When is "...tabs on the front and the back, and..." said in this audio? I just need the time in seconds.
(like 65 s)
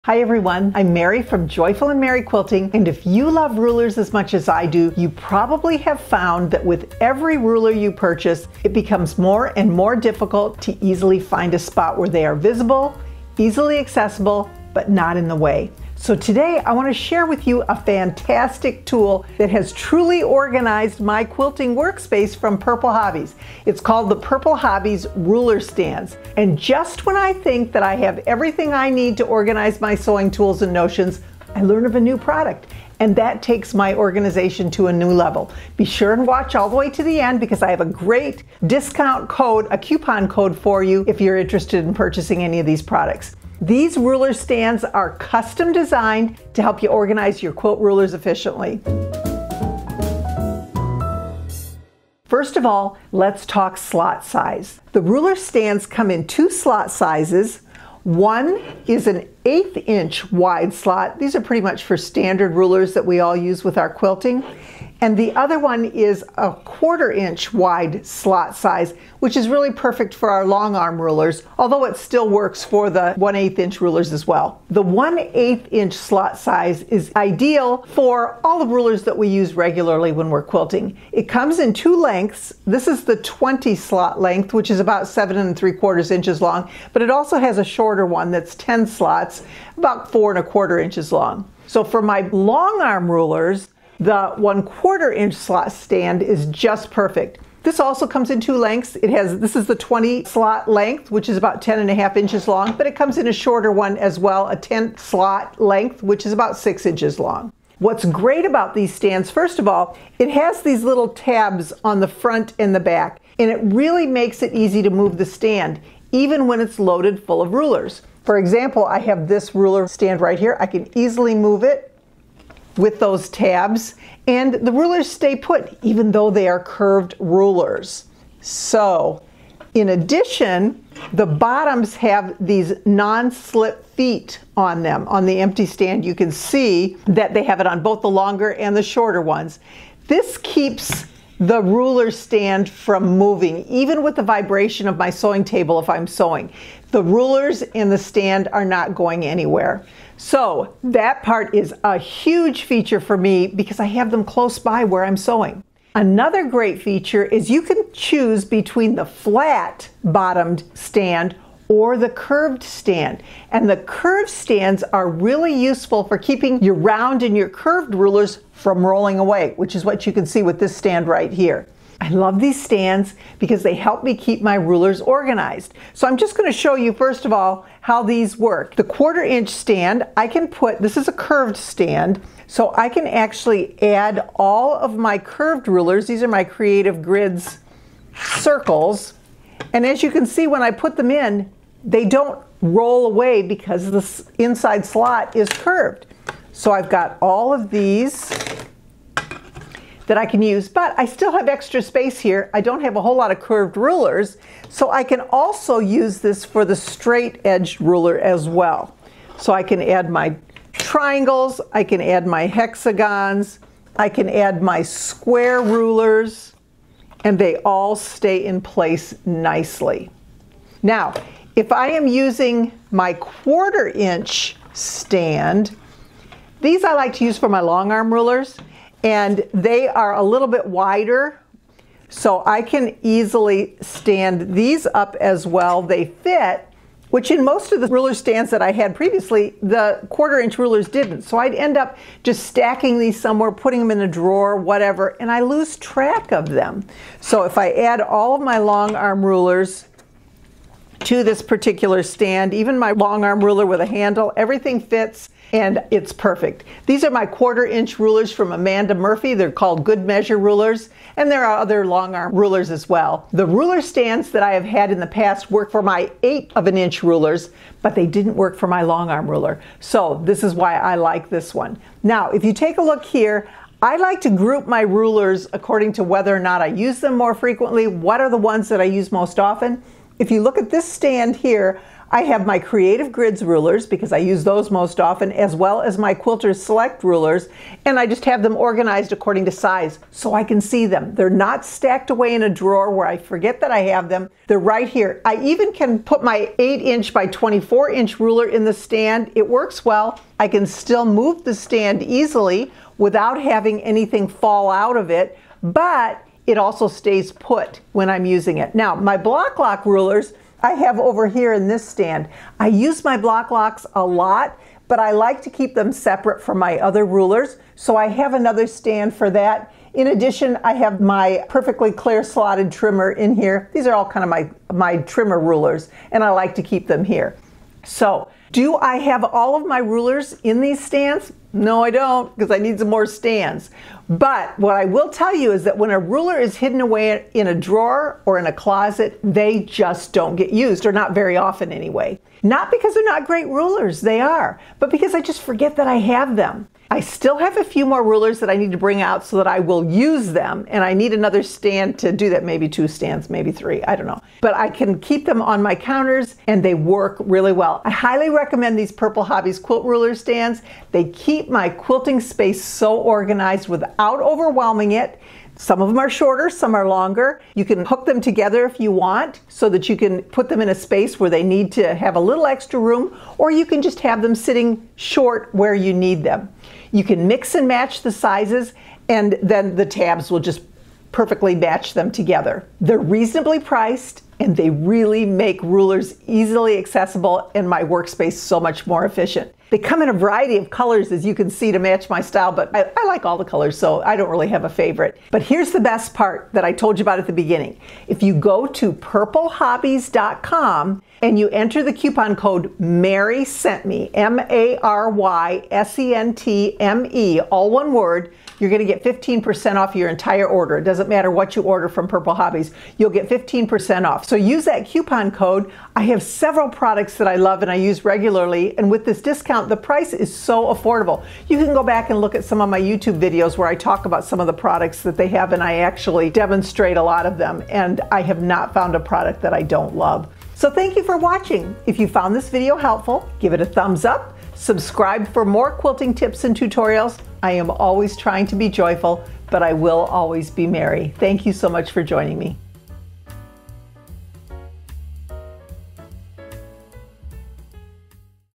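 111 s.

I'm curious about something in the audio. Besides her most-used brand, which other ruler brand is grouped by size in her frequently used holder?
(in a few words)
Quilter Select.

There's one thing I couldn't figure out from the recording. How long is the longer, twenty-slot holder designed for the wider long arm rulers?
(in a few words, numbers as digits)
10 1/2 inches.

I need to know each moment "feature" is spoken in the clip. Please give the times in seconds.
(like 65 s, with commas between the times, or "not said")
152 s, 156 s.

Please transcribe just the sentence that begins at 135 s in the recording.
On the empty stand, you can see that they have it on both the longer and the shorter ones.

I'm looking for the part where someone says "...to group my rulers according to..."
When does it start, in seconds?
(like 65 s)
274 s.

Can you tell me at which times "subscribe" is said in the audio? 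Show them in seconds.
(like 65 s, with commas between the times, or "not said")
434 s.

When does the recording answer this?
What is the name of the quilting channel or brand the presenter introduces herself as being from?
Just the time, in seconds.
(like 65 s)
1 s.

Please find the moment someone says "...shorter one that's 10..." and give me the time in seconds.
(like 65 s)
87 s.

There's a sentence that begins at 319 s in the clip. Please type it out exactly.
In addition, I have my perfectly clear slotted trimmer in here.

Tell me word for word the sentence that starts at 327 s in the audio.
So, do I have all of my rulers in these stands?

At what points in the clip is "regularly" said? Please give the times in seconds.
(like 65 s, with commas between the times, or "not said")
79 s, 418 s.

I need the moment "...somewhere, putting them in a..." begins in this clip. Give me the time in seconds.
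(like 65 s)
243 s.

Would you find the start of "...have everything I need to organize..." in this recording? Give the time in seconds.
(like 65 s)
27 s.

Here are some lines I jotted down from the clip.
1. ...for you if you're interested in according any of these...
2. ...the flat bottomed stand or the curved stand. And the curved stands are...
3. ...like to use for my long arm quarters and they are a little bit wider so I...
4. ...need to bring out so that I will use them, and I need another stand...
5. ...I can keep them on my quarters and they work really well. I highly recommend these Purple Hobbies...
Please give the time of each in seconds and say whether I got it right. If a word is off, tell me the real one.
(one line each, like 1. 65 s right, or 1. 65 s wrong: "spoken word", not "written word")
1. 40 s wrong: "purchasing", not "according"
2. 158 s right
3. 226 s wrong: "rulers", not "quarters"
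4. 348 s right
5. 354 s wrong: "counters", not "quarters".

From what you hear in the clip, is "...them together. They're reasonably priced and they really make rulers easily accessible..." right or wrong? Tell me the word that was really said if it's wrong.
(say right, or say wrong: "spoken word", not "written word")
right.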